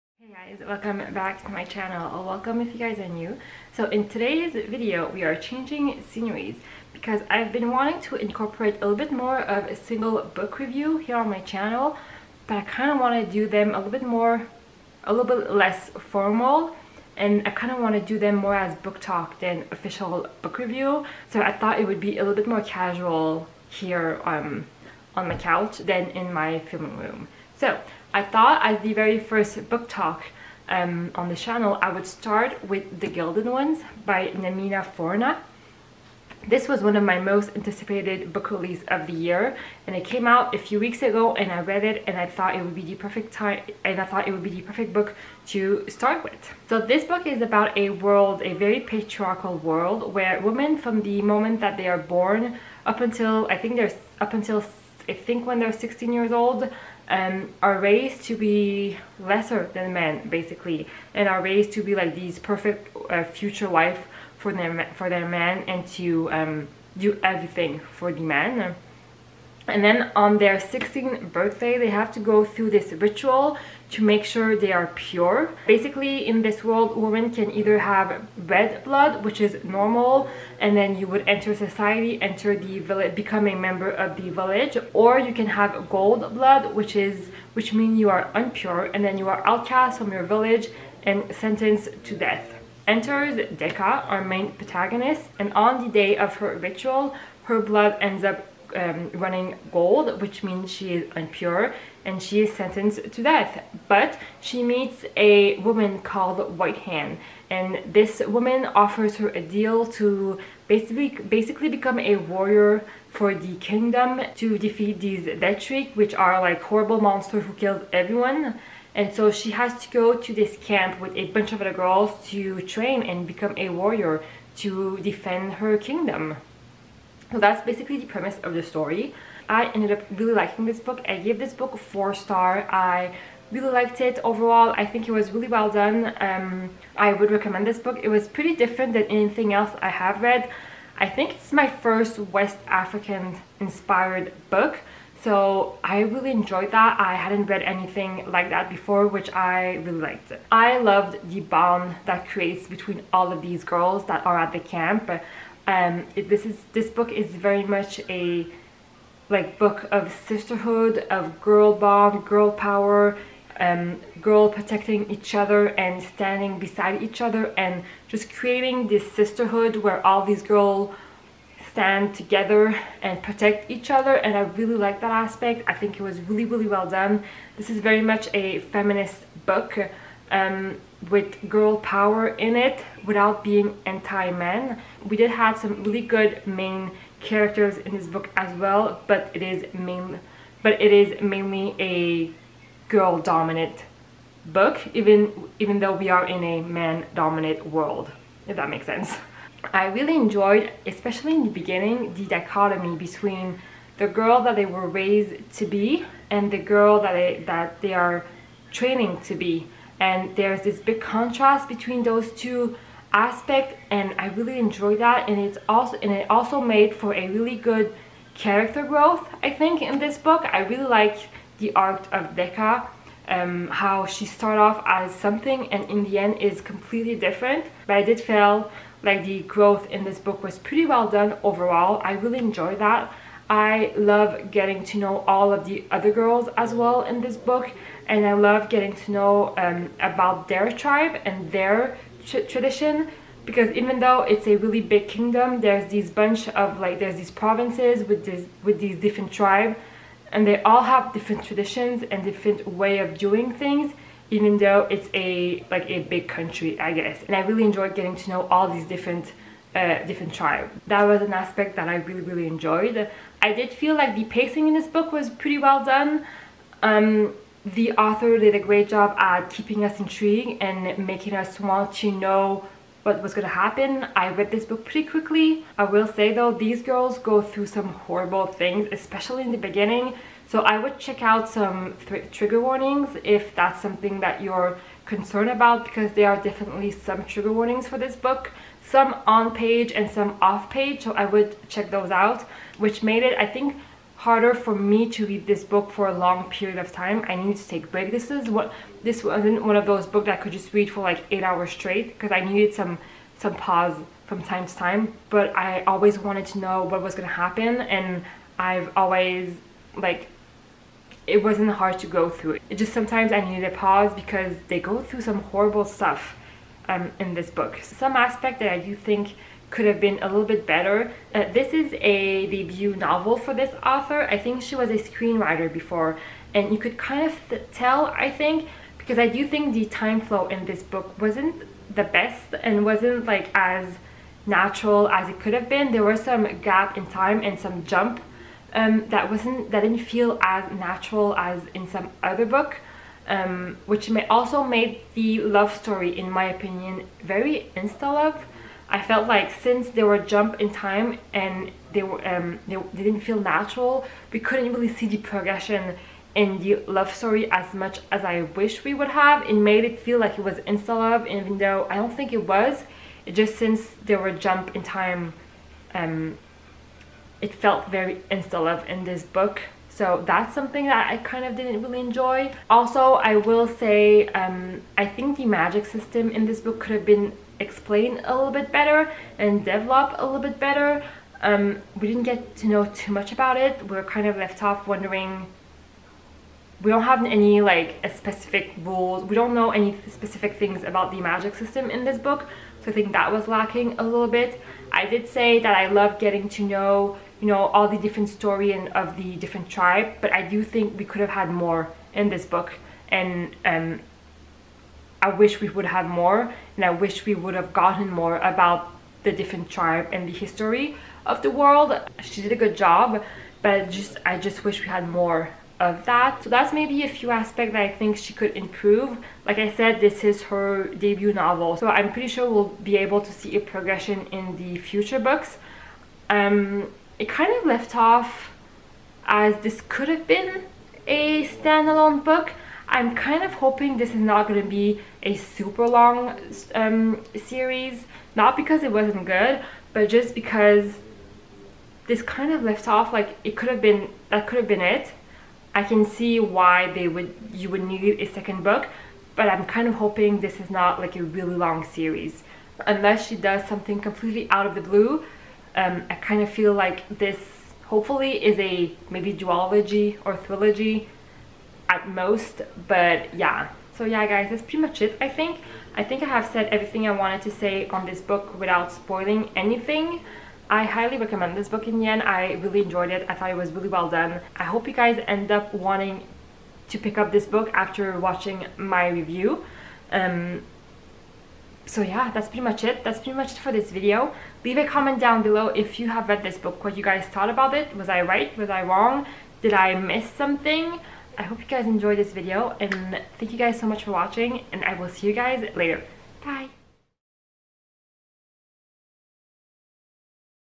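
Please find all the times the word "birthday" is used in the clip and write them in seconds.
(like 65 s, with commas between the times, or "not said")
71 s.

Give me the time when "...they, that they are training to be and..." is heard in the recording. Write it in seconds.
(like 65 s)
207 s.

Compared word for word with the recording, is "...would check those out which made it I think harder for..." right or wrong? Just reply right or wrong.
right.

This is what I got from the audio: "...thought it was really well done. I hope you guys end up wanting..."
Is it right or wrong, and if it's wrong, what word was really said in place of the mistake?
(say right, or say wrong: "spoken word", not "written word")
right.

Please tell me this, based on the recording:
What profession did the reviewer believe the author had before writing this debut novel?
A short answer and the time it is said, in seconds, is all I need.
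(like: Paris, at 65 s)
screenwriter, at 324 s.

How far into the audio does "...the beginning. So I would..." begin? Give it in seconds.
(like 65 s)
279 s.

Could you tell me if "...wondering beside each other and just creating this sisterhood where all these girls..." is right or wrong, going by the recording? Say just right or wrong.
wrong.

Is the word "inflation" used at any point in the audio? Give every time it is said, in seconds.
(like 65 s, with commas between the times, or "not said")
not said.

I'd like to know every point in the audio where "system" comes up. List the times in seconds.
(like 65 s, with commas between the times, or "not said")
375 s, 391 s.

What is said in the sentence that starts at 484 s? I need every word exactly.
Leave a comment down below if you have read this book, what you guys thought about it.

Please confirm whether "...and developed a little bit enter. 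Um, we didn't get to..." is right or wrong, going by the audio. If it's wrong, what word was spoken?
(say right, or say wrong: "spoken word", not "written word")
wrong: "better", not "enter".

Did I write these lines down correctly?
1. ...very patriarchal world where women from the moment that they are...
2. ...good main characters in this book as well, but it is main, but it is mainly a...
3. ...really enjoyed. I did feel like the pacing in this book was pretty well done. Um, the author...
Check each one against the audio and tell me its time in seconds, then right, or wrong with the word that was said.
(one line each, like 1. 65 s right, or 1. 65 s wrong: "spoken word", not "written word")
1. 48 s right
2. 186 s right
3. 262 s right.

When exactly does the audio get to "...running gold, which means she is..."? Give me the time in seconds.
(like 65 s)
99 s.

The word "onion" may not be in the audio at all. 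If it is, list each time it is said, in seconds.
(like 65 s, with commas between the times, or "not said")
not said.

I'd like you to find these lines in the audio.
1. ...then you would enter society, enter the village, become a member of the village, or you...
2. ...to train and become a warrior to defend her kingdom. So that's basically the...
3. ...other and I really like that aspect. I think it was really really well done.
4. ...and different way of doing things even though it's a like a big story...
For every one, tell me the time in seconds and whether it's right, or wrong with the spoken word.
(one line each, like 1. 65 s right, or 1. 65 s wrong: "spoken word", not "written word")
1. 80 s right
2. 122 s right
3. 173 s right
4. 252 s wrong: "country", not "story".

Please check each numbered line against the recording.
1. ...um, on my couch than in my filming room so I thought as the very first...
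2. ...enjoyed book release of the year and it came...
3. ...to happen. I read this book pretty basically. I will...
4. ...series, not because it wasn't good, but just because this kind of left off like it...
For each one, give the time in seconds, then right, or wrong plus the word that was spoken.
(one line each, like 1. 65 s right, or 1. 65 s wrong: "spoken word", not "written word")
1. 24 s right
2. 37 s wrong: "anticipated", not "enjoyed"
3. 273 s wrong: "quickly", not "basically"
4. 437 s right.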